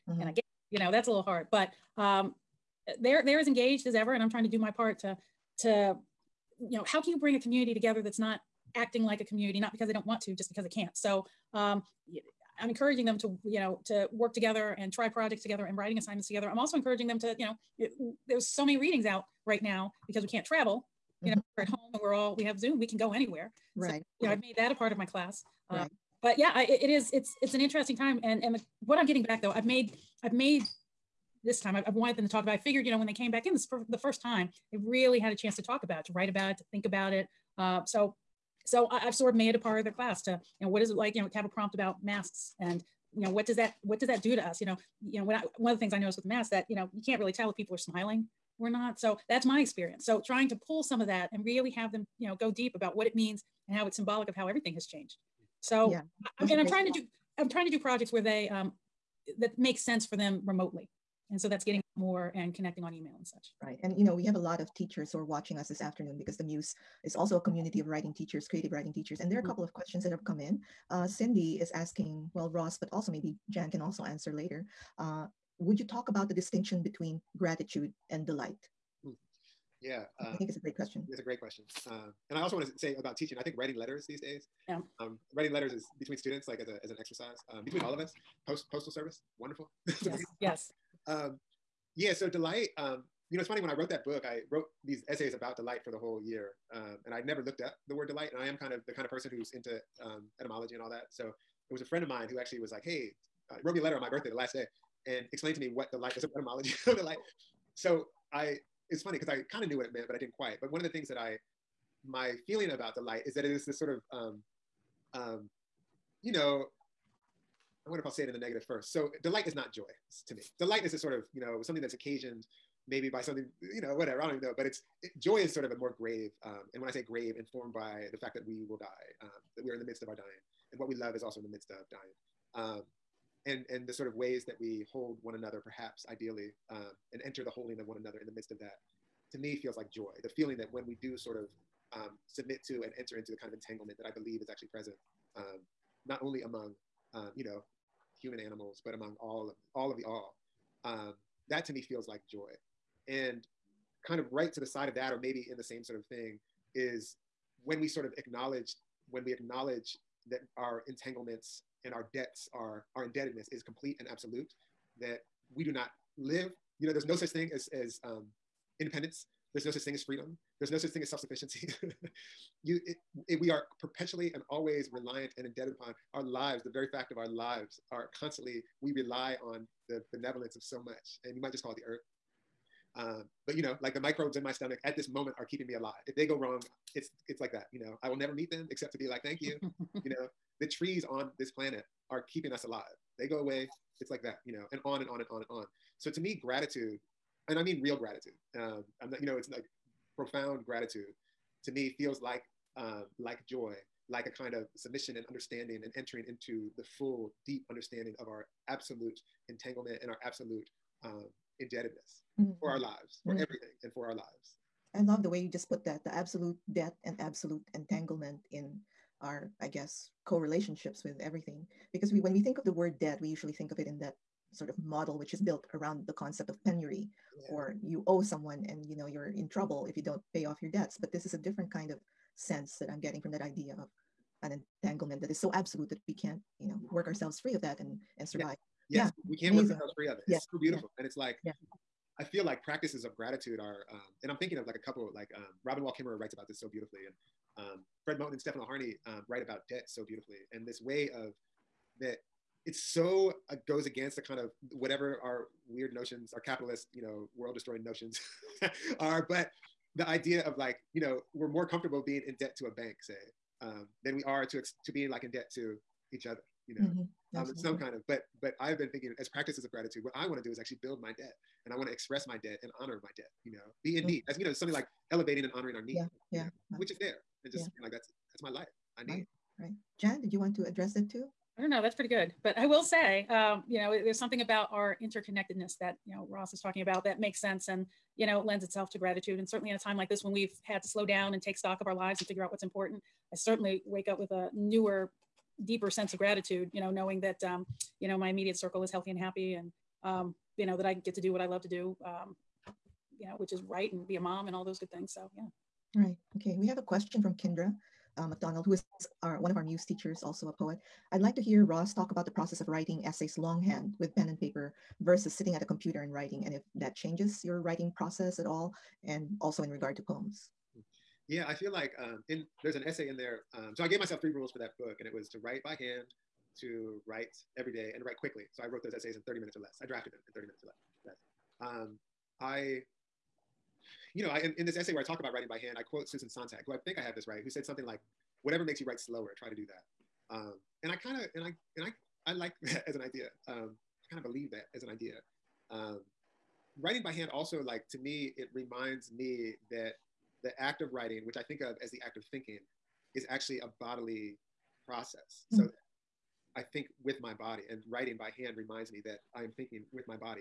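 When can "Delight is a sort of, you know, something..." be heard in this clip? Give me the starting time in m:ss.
2:00.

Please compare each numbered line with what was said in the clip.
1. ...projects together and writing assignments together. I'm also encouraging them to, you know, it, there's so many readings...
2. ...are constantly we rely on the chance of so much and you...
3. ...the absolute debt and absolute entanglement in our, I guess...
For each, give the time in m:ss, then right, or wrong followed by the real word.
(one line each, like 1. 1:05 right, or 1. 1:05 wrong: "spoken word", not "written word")
1. 0:15 right
2. 2:57 wrong: "benevolence", not "chance"
3. 3:36 right.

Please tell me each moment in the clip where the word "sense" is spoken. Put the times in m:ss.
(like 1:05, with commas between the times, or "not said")
0:59, 3:52, 4:47, 4:55.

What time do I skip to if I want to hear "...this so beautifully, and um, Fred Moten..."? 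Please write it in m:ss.
4:06.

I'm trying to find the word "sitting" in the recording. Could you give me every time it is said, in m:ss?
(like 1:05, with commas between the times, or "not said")
5:15.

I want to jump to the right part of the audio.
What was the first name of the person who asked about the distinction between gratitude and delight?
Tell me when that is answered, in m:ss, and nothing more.
1:11.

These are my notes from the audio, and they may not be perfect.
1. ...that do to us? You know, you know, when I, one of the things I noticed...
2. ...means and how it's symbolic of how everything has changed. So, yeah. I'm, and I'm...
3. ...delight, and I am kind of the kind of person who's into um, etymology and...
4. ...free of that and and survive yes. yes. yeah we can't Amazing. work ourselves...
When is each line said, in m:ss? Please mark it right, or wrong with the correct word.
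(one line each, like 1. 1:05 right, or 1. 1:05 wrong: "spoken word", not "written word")
1. 0:44 right
2. 0:53 right
3. 1:38 right
4. 3:57 right.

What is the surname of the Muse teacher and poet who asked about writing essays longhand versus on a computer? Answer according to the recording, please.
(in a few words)
McDonald.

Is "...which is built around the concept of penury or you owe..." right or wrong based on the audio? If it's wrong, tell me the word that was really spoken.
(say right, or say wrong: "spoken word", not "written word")
right.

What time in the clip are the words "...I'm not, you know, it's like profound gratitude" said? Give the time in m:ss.
3:19.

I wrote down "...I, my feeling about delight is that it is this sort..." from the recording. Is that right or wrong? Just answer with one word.
right.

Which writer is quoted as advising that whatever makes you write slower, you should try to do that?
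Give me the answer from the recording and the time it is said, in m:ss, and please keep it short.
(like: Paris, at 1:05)
Susan Sontag, at 5:36.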